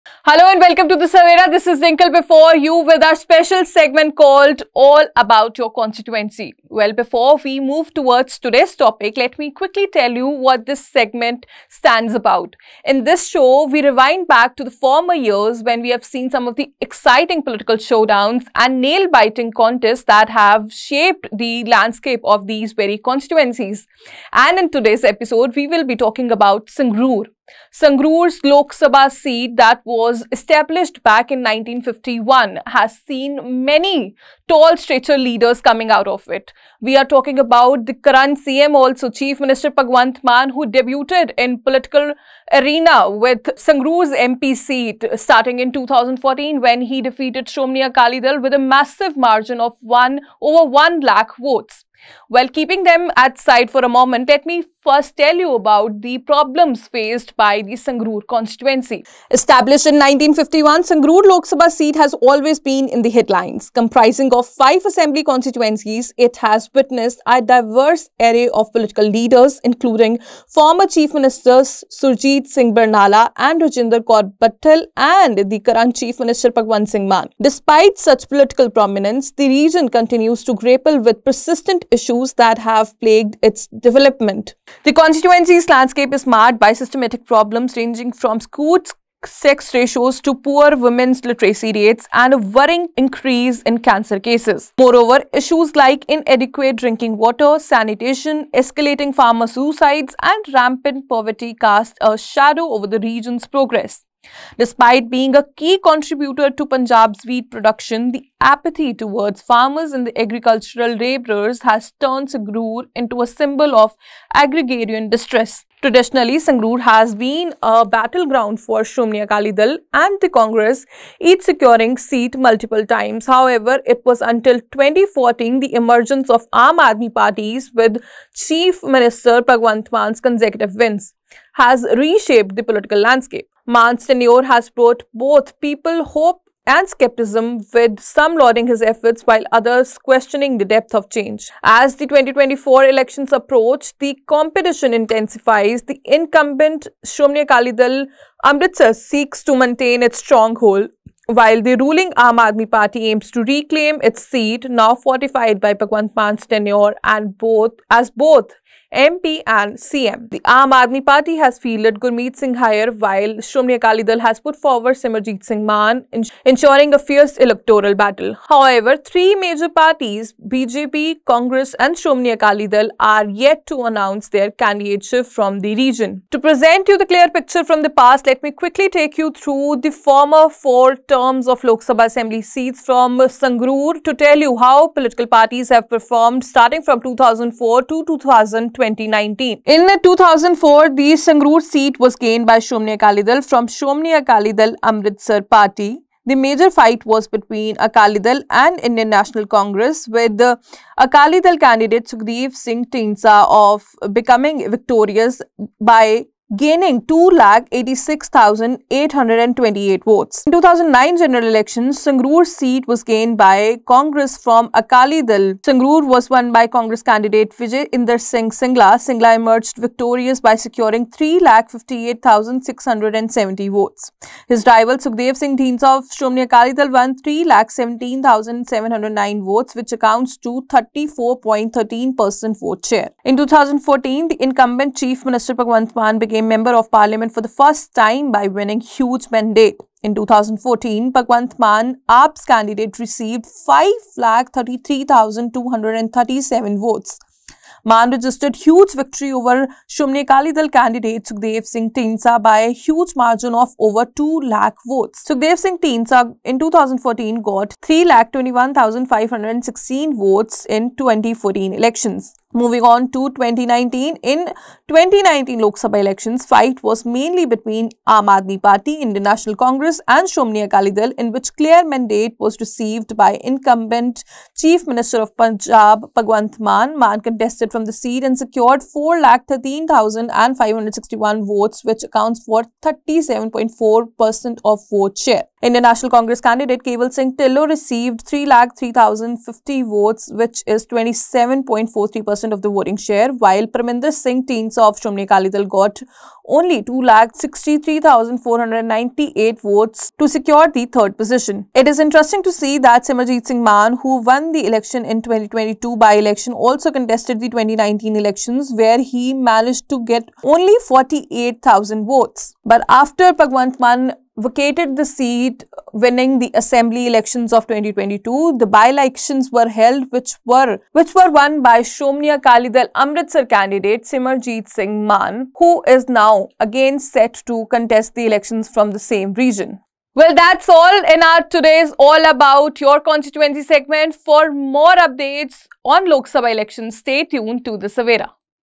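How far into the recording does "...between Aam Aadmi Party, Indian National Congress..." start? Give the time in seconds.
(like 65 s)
267 s.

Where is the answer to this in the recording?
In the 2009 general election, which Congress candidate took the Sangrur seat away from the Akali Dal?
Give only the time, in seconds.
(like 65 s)
217 s.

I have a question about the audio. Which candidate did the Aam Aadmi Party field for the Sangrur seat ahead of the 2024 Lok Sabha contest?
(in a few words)
Gurmeet Singh Hayer.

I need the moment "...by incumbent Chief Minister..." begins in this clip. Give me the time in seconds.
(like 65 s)
273 s.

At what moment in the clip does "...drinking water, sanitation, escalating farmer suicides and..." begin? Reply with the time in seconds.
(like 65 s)
96 s.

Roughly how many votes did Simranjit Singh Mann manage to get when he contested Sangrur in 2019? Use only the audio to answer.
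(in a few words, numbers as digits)
48,000.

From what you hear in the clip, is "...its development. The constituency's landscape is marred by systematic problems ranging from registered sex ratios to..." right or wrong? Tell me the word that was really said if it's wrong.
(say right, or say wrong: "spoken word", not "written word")
wrong: "skewed", not "registered".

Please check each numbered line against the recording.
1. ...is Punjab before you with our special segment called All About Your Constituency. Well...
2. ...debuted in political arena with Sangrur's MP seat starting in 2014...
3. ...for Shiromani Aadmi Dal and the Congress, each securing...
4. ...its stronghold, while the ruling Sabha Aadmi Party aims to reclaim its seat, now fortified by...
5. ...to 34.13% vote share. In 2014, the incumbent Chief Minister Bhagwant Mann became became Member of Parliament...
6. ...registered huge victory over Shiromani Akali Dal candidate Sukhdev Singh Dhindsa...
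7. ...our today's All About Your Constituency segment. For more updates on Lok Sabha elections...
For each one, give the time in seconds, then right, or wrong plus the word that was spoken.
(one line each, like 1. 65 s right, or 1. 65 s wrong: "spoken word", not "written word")
1. 1 s wrong: "Dinkle", not "Punjab"
2. 40 s right
3. 118 s wrong: "Akali", not "Aadmi"
4. 150 s wrong: "Aam", not "Sabha"
5. 230 s right
6. 248 s right
7. 331 s right.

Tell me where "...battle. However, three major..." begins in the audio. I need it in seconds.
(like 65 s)
167 s.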